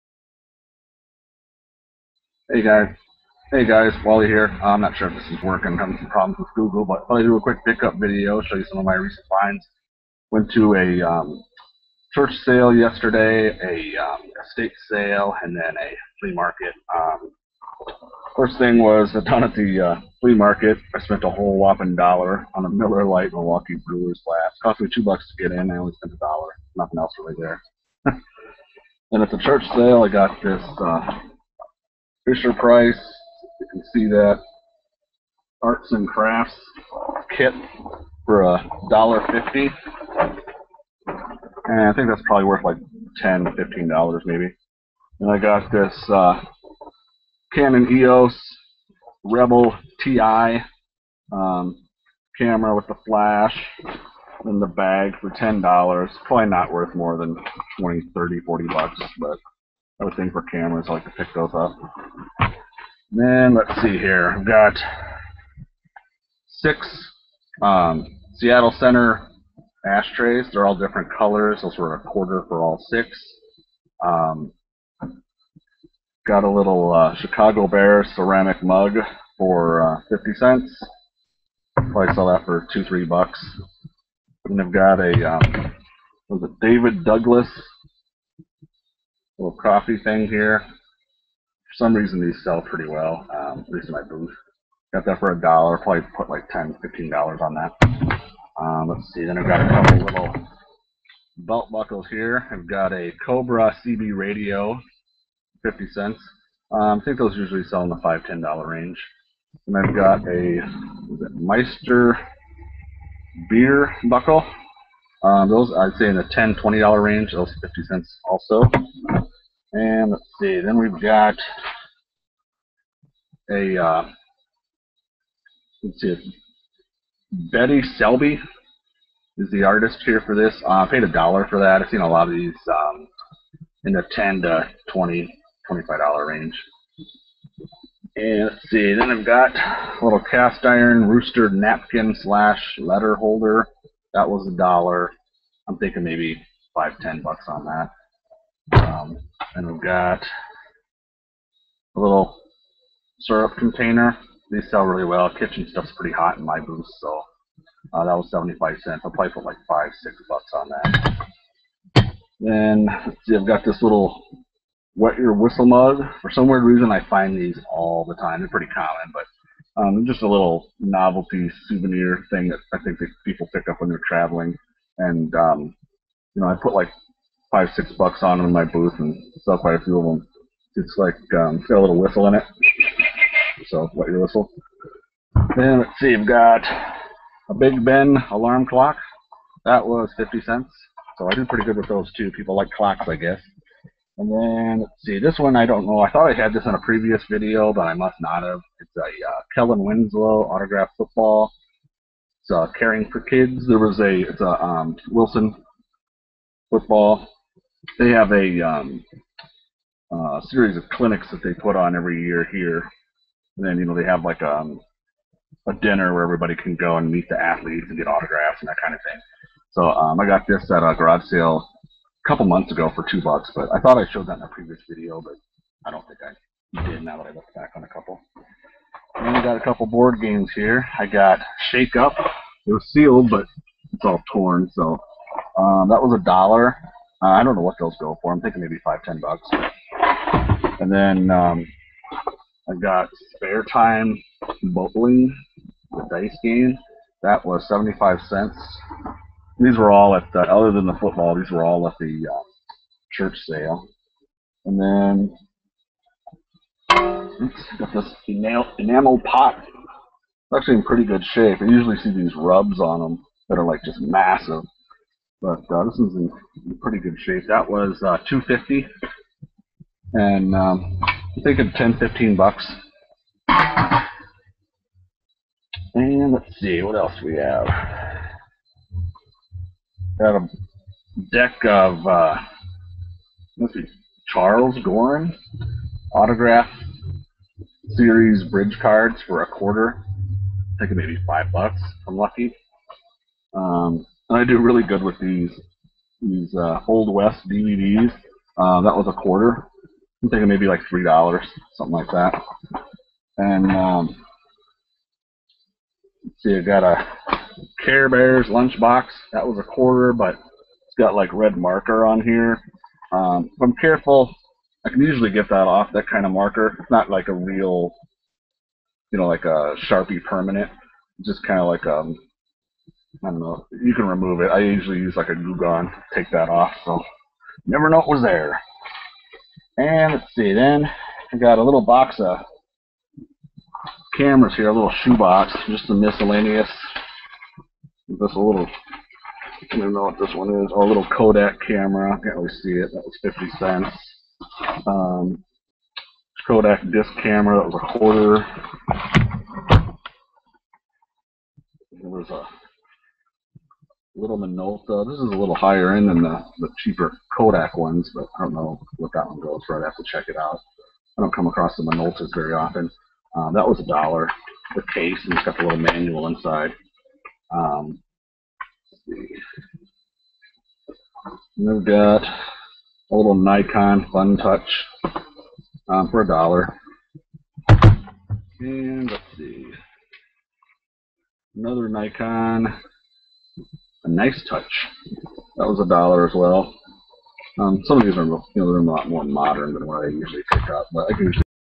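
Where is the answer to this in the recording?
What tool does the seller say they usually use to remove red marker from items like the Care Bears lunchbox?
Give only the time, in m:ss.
5:25.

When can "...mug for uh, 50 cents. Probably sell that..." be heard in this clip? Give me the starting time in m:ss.
1:18.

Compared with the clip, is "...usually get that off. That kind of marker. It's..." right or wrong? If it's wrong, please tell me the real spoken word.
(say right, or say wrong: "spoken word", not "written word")
right.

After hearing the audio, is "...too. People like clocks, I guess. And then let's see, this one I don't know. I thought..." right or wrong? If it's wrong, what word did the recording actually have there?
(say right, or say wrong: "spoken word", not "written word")
right.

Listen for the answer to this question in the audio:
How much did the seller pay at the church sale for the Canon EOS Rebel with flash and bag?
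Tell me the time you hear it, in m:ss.
0:55.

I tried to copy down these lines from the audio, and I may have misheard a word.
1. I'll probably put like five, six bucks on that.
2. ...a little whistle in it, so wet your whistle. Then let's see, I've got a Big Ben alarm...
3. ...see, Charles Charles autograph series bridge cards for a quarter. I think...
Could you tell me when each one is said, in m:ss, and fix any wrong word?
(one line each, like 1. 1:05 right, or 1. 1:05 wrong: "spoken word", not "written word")
1. 2:39 right
2. 3:01 right
3. 4:43 wrong: "Goren", not "Charles".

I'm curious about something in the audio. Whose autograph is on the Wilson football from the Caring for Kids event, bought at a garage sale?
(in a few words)
Kellen Winslow.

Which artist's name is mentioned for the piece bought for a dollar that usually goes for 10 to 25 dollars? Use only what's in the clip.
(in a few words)
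Betty Selby.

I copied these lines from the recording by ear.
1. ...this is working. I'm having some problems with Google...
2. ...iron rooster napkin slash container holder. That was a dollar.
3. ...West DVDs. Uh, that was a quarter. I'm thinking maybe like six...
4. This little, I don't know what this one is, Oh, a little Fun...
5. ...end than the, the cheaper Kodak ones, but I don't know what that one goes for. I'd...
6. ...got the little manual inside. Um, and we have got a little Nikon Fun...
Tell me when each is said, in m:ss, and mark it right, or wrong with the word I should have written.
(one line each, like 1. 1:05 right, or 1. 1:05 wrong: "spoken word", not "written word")
1. 0:05 right
2. 2:20 wrong: "letter", not "container"
3. 4:57 wrong: "three", not "six"
4. 5:38 wrong: "Kodak", not "Fun"
5. 5:55 right
6. 6:05 right.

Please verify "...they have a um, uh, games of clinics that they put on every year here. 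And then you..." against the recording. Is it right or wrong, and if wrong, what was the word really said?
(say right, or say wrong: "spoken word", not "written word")
wrong: "series", not "games".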